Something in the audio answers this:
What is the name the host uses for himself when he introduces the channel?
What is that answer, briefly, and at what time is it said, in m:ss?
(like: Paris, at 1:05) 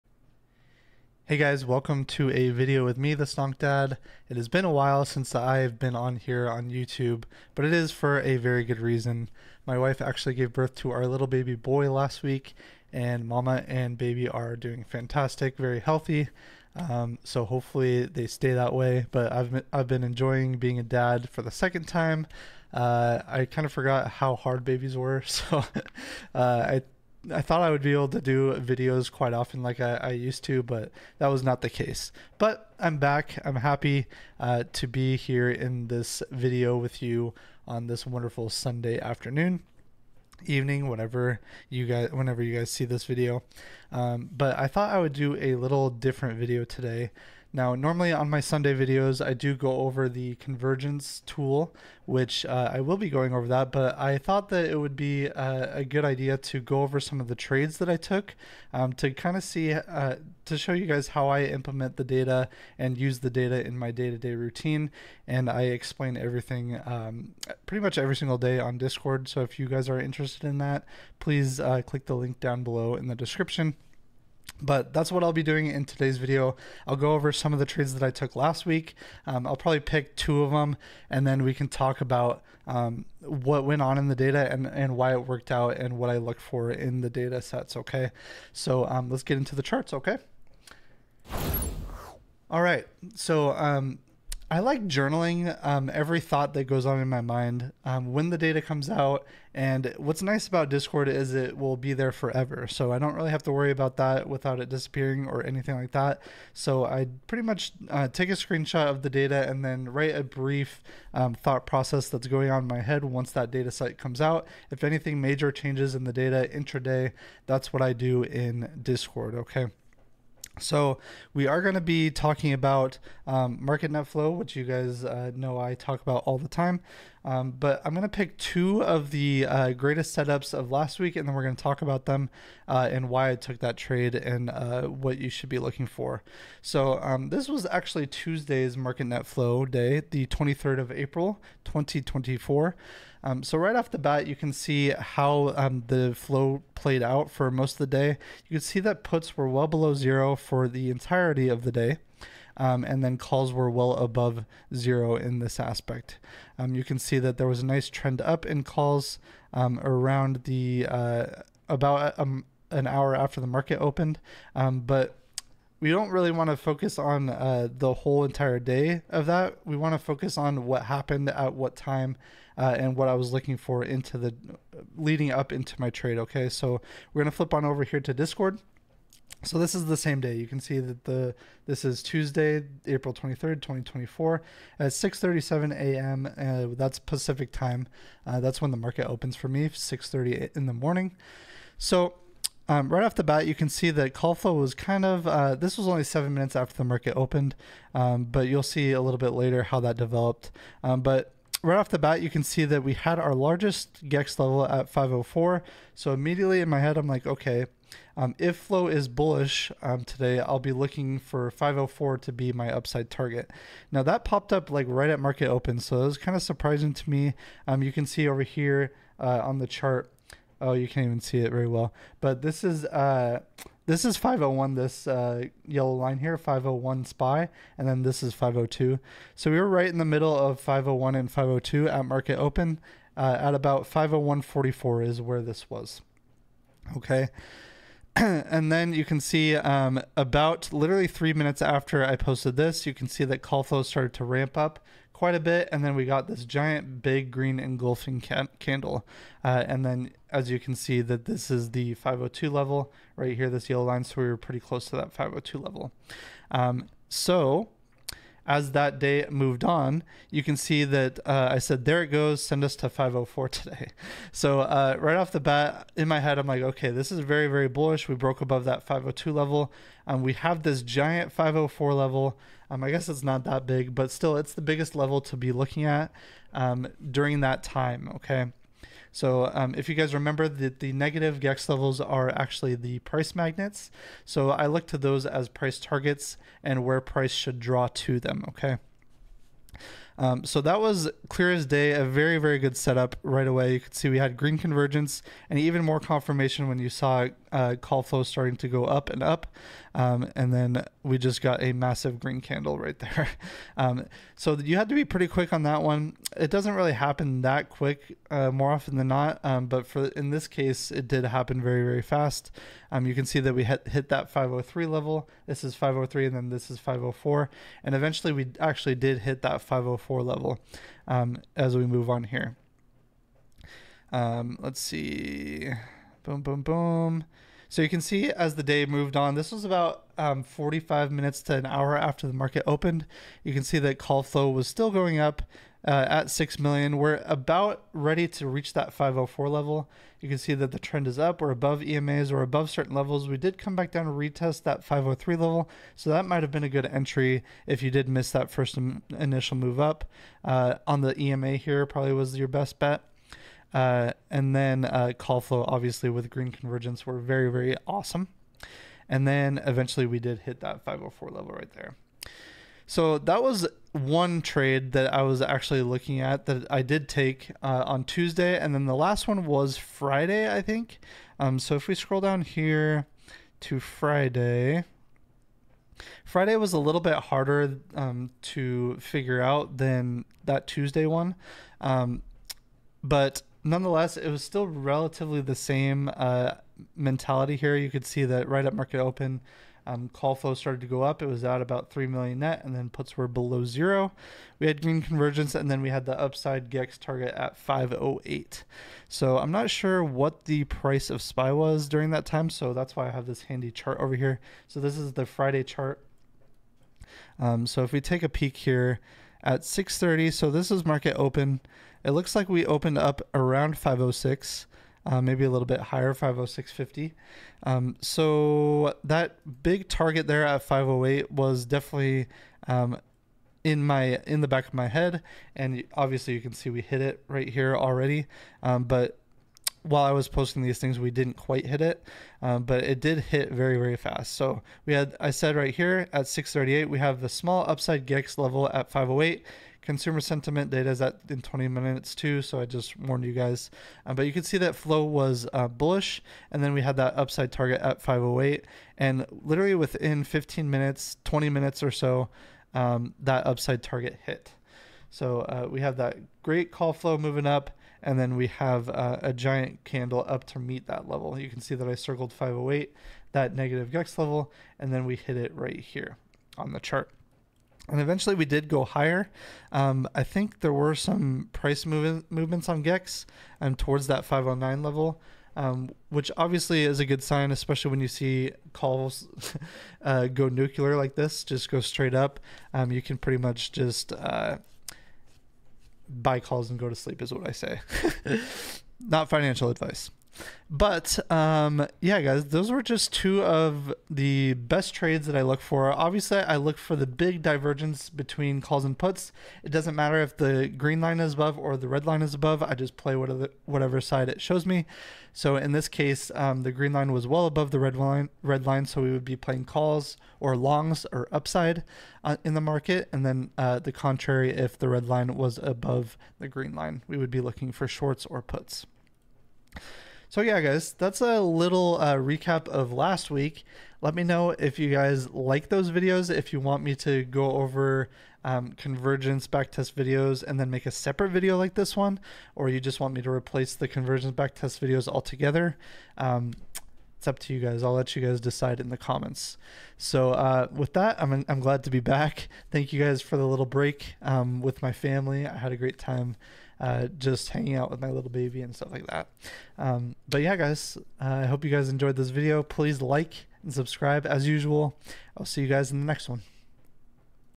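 the Stonk Dad, at 0:03.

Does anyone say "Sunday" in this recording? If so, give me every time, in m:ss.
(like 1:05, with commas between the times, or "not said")
0:38, 0:48.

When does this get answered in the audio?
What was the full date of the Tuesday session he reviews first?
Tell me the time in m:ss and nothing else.
2:20.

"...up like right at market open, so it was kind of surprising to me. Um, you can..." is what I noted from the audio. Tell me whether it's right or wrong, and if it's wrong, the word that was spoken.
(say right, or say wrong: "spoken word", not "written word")
right.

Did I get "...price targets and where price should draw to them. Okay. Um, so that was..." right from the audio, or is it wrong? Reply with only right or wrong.
right.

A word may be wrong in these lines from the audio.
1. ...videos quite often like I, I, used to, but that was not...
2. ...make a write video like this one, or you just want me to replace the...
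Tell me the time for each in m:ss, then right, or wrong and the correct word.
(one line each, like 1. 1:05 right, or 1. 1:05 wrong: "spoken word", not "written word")
1. 0:28 right
2. 8:50 wrong: "separate", not "write".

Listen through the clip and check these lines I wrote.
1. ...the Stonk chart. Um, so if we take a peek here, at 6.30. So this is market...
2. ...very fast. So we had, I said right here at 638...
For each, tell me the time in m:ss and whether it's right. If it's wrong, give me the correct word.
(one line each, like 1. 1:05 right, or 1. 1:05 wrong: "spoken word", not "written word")
1. 6:45 wrong: "Friday", not "Stonk"
2. 7:13 right.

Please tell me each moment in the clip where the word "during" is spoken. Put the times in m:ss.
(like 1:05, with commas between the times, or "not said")
4:37, 6:41.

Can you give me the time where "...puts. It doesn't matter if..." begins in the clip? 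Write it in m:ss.
8:18.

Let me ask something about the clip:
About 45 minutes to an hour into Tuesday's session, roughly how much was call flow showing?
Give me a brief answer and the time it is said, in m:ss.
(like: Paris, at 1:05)
6 million, at 5:36.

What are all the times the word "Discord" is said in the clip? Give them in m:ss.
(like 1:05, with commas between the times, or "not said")
1:08, 1:40, 1:58, 2:58.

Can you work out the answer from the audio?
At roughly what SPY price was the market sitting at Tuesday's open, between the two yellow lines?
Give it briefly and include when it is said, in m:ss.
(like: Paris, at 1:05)
501.44, at 3:53.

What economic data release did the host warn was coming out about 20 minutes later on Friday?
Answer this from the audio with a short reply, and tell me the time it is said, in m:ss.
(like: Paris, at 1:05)
Consumer sentiment, at 7:19.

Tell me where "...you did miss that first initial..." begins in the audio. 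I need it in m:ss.
5:47.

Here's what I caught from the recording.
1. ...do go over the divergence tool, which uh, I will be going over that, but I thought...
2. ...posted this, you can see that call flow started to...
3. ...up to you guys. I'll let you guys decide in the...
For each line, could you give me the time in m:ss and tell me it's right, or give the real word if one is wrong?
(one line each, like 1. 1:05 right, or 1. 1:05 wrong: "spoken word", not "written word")
1. 0:49 wrong: "convergence", not "divergence"
2. 4:02 right
3. 8:57 right.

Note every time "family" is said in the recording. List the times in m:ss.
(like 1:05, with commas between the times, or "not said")
9:04.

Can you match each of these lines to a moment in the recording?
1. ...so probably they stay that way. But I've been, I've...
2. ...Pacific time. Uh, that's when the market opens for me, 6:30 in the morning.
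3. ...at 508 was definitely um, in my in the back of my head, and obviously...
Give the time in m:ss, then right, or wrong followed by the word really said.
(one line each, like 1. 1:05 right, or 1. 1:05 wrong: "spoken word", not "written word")
1. 0:17 wrong: "hopefully", not "probably"
2. 3:06 right
3. 7:00 right.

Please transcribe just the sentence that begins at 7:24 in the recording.
Um, but you can see that flow was uh, bullish, and then we had that upside target at 508.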